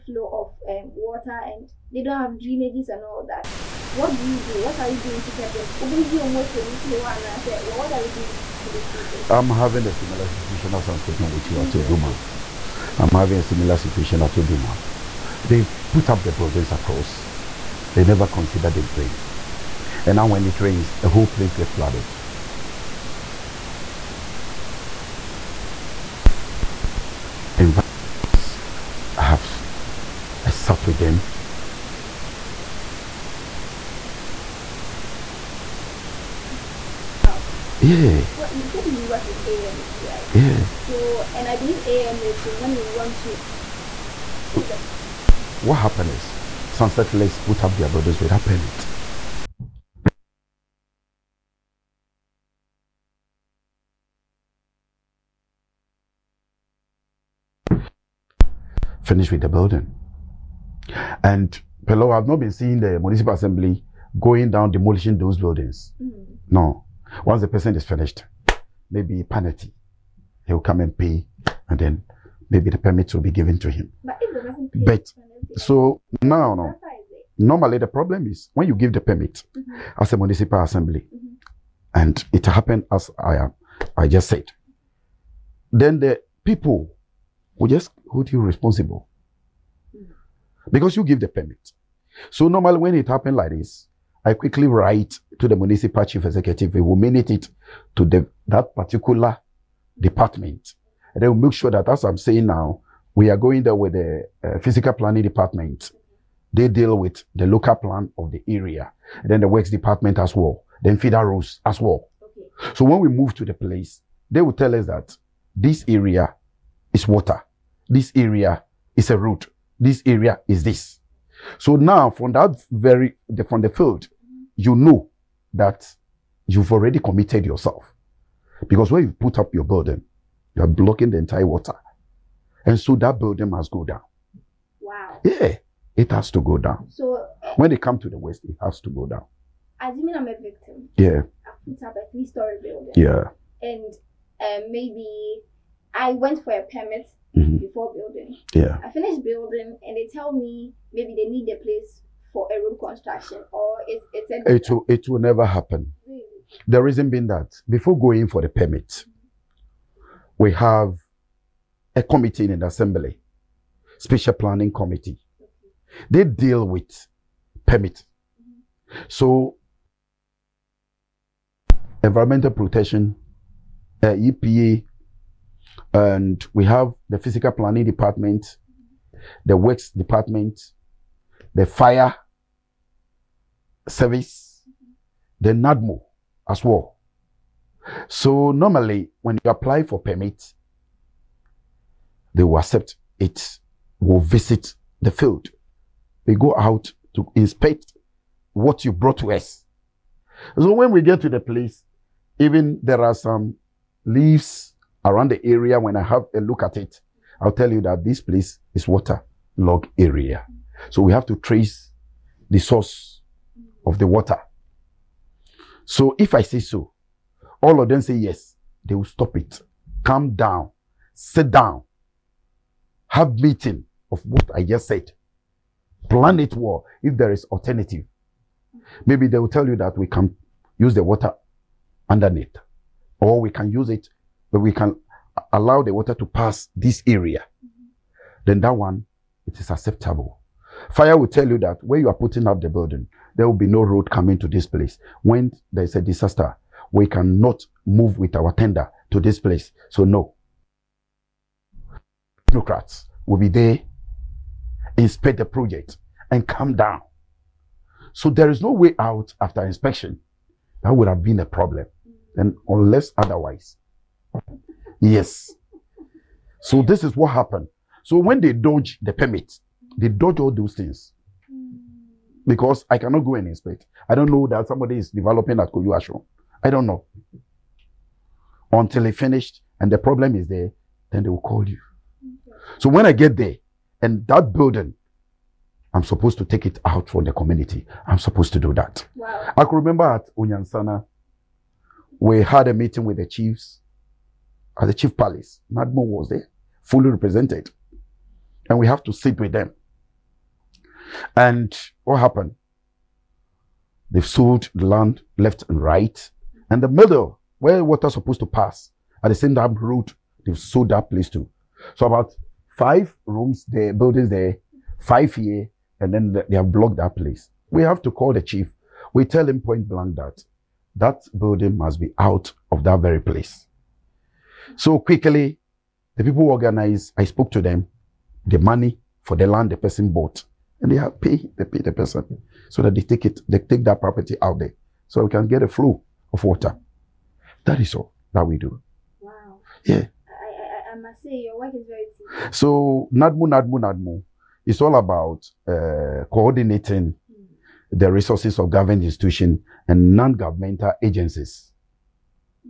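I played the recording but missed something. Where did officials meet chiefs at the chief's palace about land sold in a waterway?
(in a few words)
Unyansana.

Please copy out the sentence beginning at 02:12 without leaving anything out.
And so that burden must go down.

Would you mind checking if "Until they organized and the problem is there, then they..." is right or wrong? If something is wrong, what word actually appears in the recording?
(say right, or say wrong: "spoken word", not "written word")
wrong: "finished", not "organized".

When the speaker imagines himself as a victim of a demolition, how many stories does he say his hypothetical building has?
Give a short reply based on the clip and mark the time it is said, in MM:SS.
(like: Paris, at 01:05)
3, at 02:22.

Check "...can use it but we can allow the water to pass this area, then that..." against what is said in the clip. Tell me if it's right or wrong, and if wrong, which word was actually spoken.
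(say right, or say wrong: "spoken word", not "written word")
right.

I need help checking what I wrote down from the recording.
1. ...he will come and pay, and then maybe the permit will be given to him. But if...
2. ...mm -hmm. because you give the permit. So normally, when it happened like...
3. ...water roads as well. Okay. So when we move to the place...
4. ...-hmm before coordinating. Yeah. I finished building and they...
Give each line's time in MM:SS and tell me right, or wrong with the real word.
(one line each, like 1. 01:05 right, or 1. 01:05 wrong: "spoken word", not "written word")
1. 01:10 right
2. 01:29 right
3. 01:50 wrong: "feeder", not "water"
4. 02:27 wrong: "building", not "coordinating".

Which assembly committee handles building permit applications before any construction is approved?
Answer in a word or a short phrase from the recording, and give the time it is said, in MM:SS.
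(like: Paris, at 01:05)
spatial planning committee, at 02:43.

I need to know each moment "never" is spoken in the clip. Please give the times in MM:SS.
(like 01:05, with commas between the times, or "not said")
00:18, 02:35.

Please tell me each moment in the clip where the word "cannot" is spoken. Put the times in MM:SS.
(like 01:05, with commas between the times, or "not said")
04:07, 04:32.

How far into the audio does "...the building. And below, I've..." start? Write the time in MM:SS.
00:59.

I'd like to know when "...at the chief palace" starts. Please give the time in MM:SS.
04:54.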